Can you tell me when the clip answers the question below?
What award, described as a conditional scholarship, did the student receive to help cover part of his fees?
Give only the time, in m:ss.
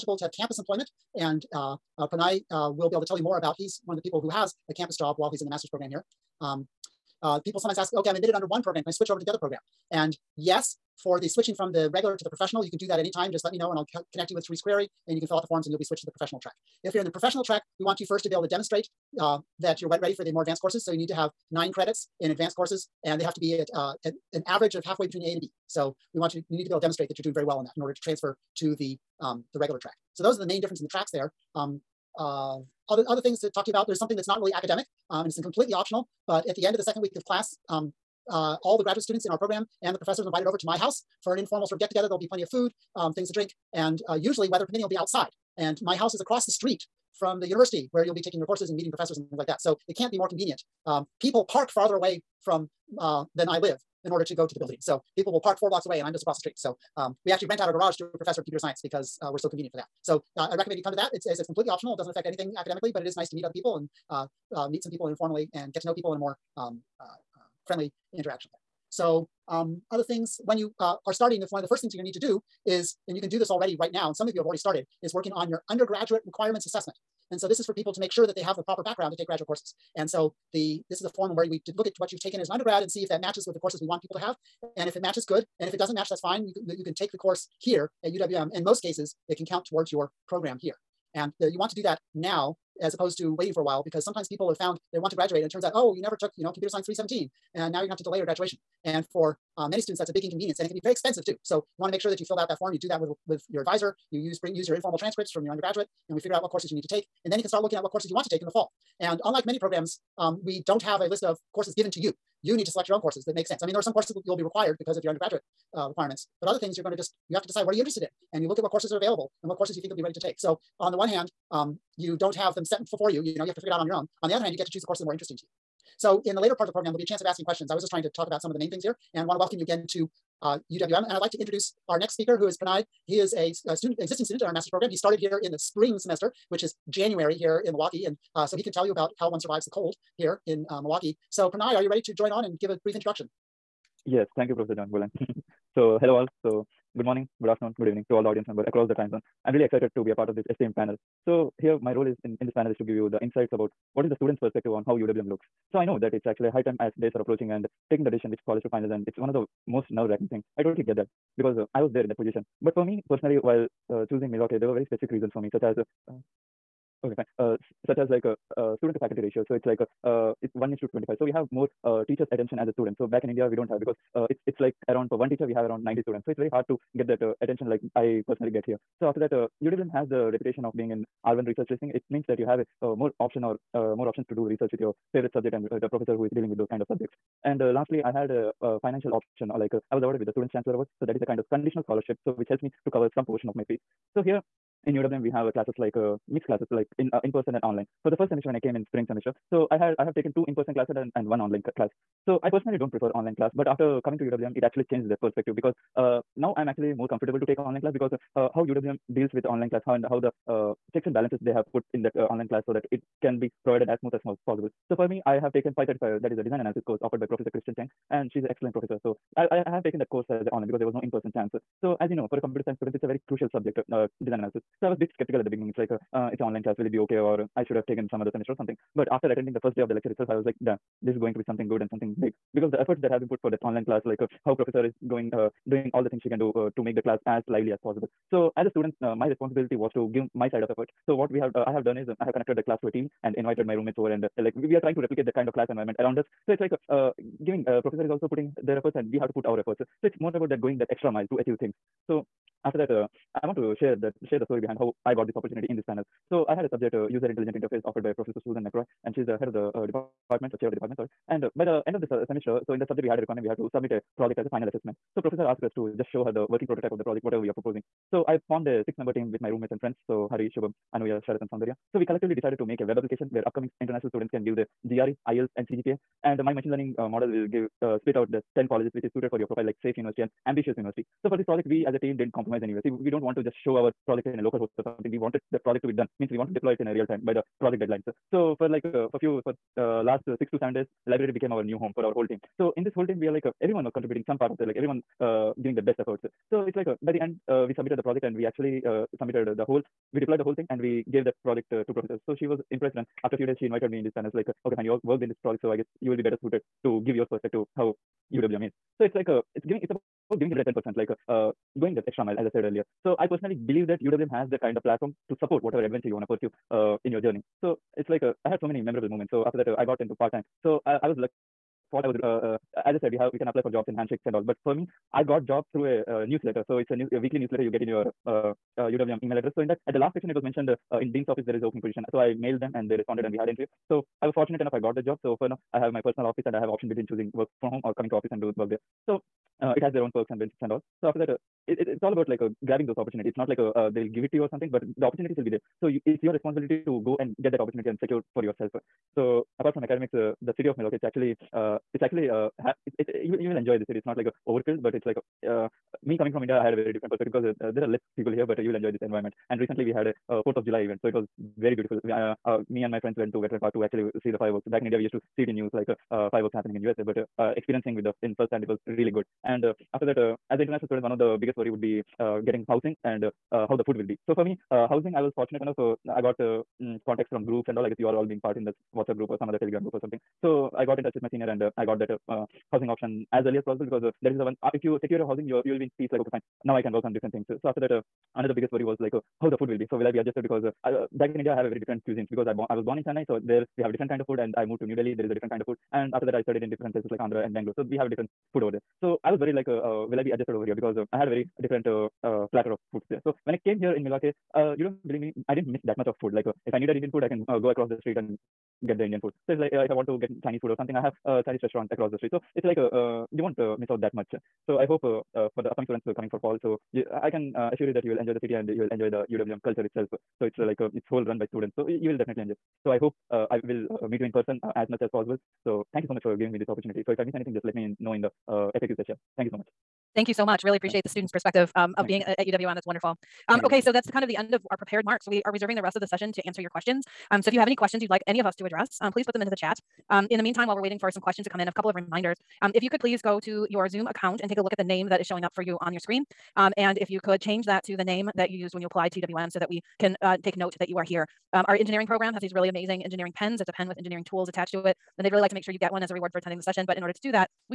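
3:10.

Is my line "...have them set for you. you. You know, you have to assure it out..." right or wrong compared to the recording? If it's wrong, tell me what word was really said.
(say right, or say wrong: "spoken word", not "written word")
wrong: "figure", not "assure".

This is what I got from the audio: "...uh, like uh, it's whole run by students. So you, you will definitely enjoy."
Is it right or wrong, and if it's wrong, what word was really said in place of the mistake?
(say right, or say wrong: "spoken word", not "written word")
right.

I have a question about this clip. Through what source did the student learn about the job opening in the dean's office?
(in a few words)
weekly newsletter.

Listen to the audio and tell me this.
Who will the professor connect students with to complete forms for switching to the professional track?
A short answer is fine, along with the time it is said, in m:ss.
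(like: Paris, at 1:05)
Therese Query, at 0:14.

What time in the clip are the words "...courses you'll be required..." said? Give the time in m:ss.
1:53.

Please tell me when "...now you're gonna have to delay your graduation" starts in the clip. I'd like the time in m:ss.
1:37.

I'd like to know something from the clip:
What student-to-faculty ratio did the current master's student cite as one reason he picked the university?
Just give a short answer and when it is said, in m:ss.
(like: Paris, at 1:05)
1 to 25, at 2:50.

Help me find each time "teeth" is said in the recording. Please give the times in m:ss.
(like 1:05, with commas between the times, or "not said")
not said.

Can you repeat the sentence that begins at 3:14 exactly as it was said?
So here in UWM, we have classes like uh, mixed classes, like in uh, in person and online.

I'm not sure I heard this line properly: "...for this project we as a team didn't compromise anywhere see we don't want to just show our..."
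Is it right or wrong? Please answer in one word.
right.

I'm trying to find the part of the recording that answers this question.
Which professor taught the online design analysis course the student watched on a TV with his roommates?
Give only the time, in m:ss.
3:37.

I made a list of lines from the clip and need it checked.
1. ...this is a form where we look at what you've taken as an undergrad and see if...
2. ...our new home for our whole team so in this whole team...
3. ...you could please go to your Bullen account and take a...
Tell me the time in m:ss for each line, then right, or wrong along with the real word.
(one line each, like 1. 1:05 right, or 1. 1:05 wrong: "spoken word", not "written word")
1. 1:20 right
2. 4:51 right
3. 7:22 wrong: "Zoom", not "Bullen".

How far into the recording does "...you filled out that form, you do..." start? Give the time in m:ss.
1:42.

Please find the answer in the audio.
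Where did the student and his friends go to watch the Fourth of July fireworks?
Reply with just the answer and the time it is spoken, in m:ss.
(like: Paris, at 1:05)
Veteran Park, at 6:03.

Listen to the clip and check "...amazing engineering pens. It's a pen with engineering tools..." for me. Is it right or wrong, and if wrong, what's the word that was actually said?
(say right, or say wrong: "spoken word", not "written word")
right.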